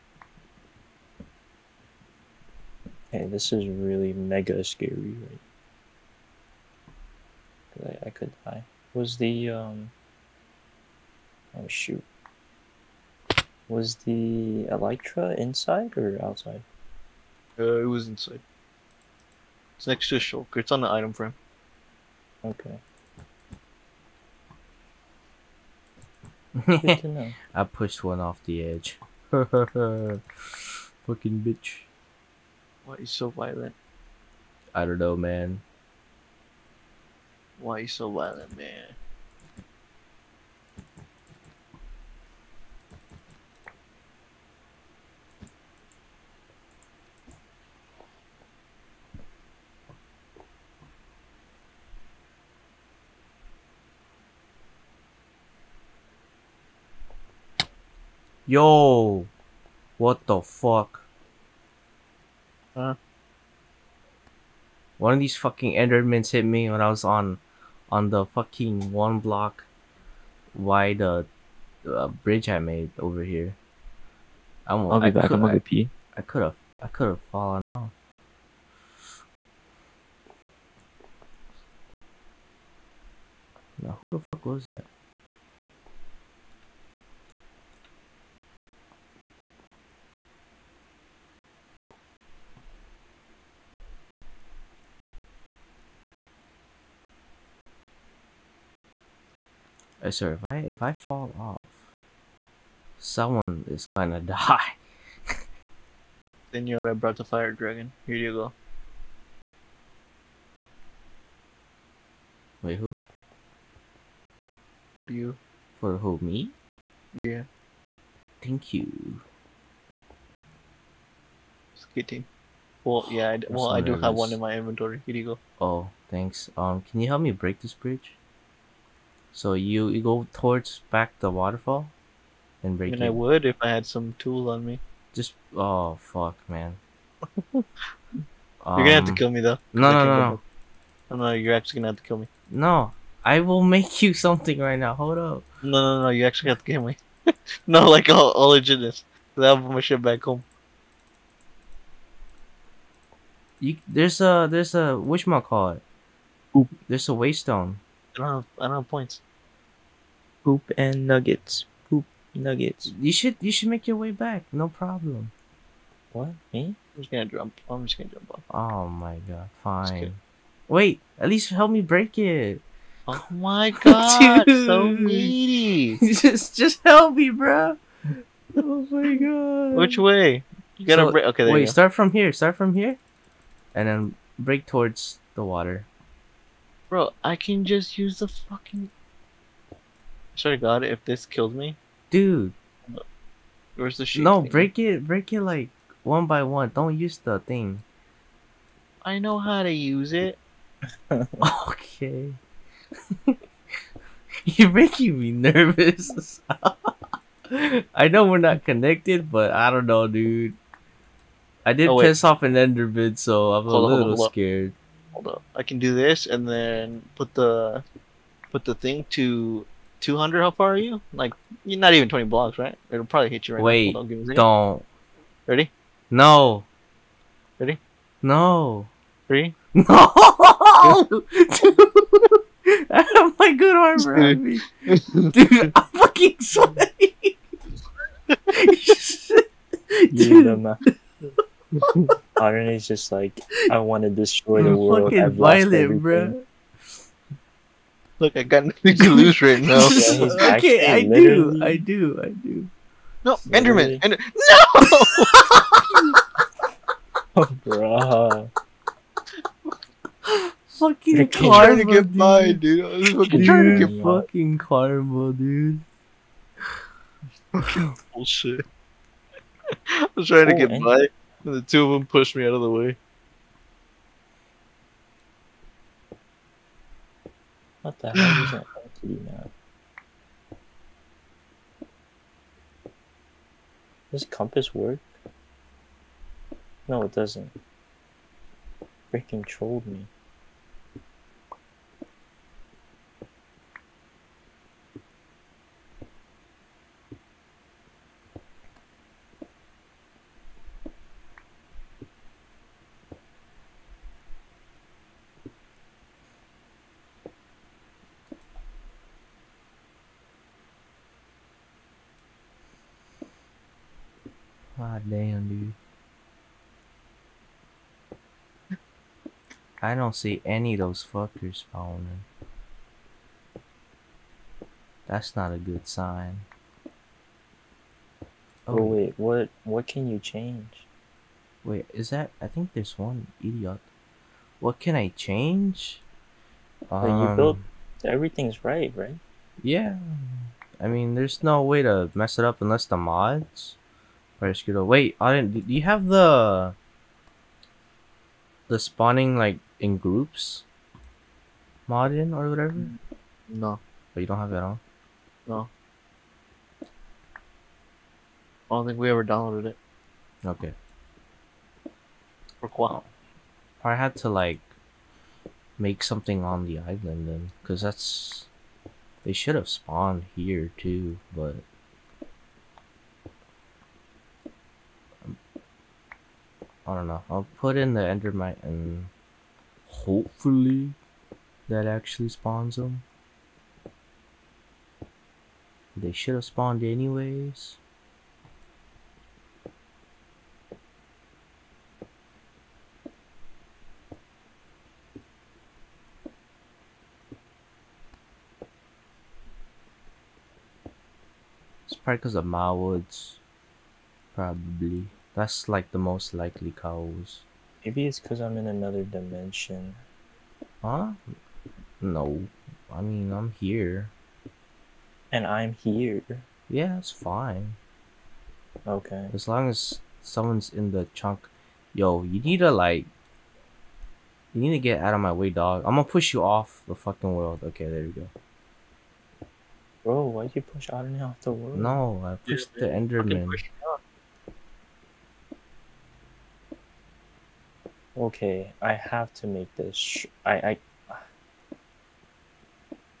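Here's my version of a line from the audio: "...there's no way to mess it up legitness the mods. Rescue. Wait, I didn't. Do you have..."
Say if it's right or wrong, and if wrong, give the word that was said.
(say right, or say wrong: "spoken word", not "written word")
wrong: "unless", not "legitness".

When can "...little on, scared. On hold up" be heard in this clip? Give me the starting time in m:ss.
3:33.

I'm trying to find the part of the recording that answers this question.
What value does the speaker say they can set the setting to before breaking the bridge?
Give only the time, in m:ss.
3:39.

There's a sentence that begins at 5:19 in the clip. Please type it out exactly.
I don't see any of those fuckers spawning.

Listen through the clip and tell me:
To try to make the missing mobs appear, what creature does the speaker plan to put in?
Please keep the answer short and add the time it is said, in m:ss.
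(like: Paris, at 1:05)
Endermite, at 6:17.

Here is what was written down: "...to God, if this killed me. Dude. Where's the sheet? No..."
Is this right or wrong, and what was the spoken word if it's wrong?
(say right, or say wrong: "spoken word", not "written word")
right.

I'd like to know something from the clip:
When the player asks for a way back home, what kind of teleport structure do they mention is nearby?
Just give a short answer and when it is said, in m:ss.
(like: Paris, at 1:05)
waystone, at 2:37.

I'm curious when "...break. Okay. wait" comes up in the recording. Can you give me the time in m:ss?
3:01.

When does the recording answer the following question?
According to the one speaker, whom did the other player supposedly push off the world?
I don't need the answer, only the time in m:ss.
7:10.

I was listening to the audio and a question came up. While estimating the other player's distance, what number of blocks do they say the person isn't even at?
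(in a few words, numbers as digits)
20.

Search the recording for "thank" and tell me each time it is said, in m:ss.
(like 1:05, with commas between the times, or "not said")
1:58, 2:06.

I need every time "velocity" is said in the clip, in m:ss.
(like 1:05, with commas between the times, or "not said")
not said.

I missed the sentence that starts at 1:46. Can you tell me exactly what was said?
then you're a breath of fire dragon.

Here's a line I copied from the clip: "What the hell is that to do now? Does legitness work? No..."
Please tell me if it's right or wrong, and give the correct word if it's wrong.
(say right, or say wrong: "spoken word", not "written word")
wrong: "compass", not "legitness".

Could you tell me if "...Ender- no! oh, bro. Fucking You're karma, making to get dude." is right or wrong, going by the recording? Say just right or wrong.
wrong.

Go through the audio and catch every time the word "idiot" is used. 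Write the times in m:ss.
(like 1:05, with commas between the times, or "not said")
5:33.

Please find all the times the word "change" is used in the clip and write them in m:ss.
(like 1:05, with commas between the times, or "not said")
5:30, 5:35.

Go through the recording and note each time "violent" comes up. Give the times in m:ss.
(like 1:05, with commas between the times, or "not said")
0:33, 0:38, 4:05.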